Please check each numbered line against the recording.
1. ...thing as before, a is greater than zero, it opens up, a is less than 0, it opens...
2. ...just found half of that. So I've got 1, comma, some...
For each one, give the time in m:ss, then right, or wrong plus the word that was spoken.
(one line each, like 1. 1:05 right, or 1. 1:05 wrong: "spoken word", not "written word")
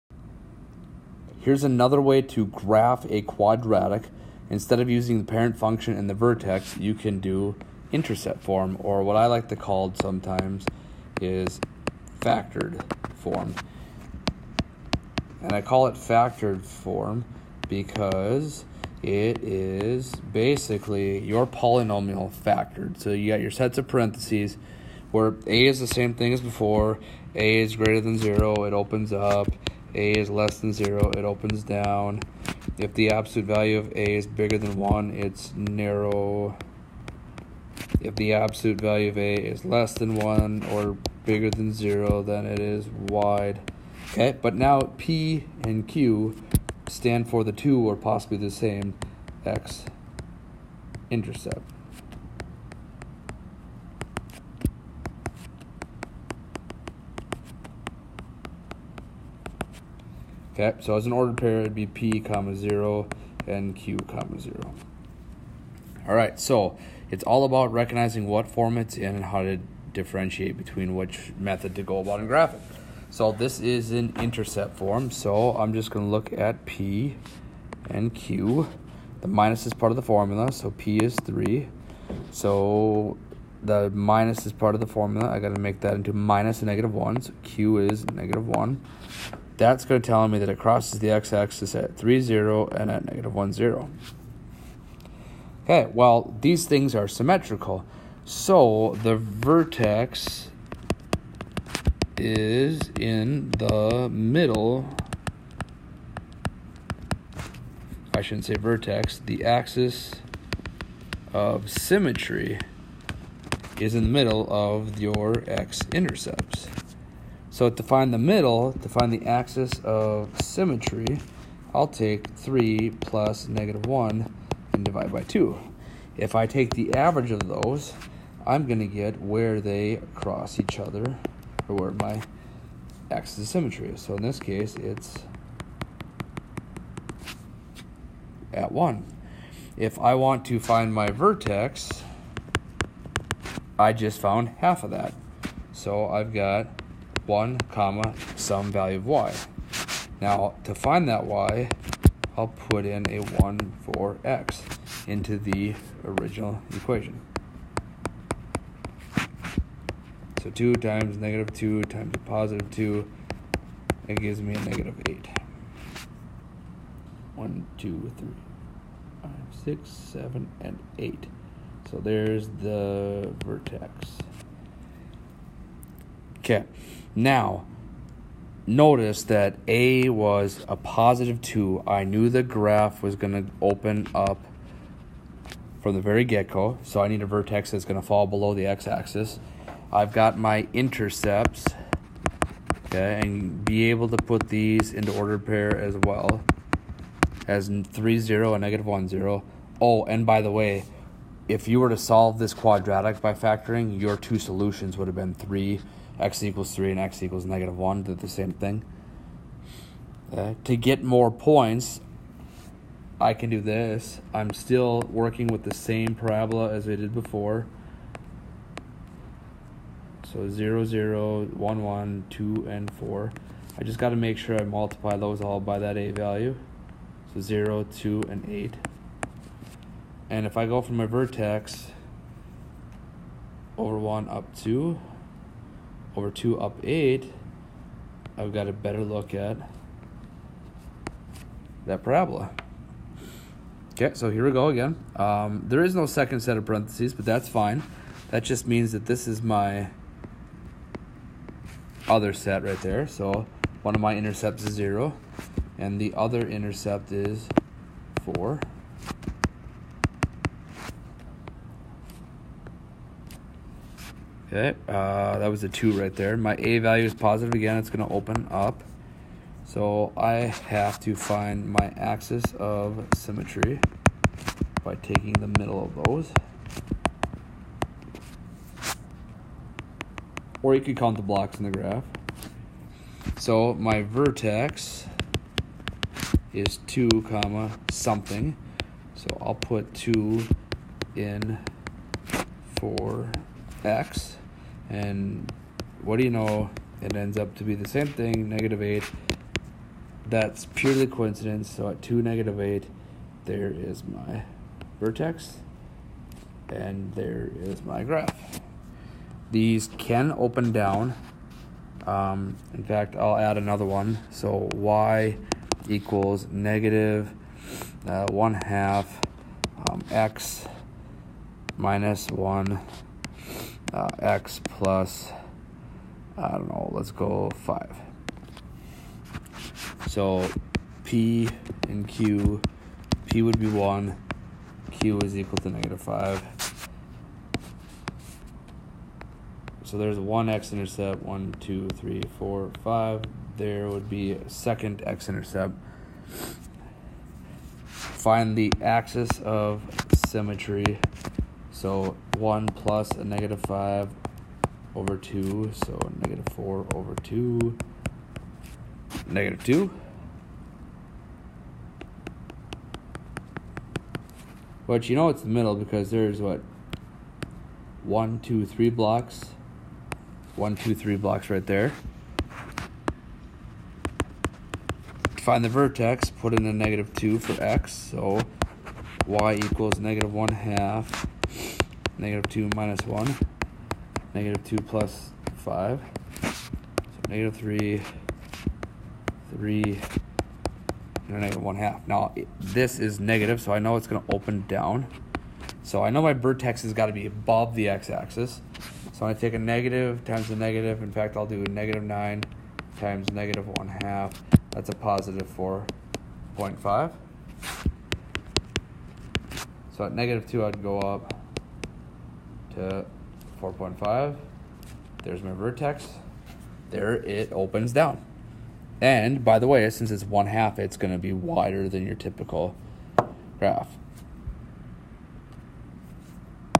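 1. 0:26 right
2. 2:23 right.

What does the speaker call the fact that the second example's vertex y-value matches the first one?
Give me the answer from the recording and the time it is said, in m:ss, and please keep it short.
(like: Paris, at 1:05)
purely coincidence, at 5:00.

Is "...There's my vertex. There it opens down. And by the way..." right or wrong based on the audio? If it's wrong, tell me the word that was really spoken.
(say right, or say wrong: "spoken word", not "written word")
right.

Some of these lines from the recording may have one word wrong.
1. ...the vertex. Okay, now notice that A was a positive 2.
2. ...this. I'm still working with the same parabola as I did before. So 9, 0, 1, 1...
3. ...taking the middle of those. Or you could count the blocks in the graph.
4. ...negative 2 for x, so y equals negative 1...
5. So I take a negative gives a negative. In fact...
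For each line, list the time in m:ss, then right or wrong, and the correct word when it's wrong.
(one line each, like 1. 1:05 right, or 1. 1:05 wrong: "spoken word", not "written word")
1. 2:52 right
2. 3:33 wrong: "0", not "9"
3. 4:34 right
4. 6:16 right
5. 6:39 wrong: "times", not "gives".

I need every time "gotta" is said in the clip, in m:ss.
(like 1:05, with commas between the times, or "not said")
1:25.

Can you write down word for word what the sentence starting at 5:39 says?
So there's one x-intercept, one, two, three, four, five.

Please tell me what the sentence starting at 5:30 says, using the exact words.
So p and q, p would be 1, q is equal to negative 5.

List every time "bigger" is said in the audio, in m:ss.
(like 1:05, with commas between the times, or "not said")
0:34, 0:41.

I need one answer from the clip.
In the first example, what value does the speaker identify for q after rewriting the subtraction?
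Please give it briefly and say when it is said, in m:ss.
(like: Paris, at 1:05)
-1, at 1:27.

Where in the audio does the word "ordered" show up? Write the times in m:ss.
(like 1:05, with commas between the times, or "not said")
1:01, 3:15.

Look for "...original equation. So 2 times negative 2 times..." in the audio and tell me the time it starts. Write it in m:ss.
2:36.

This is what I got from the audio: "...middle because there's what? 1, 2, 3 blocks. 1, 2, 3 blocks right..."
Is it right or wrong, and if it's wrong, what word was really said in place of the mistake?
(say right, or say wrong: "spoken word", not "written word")
right.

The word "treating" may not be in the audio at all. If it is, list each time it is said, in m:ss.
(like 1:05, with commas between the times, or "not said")
not said.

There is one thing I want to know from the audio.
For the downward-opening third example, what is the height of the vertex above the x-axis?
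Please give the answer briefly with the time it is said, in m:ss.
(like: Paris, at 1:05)
4.5, at 6:44.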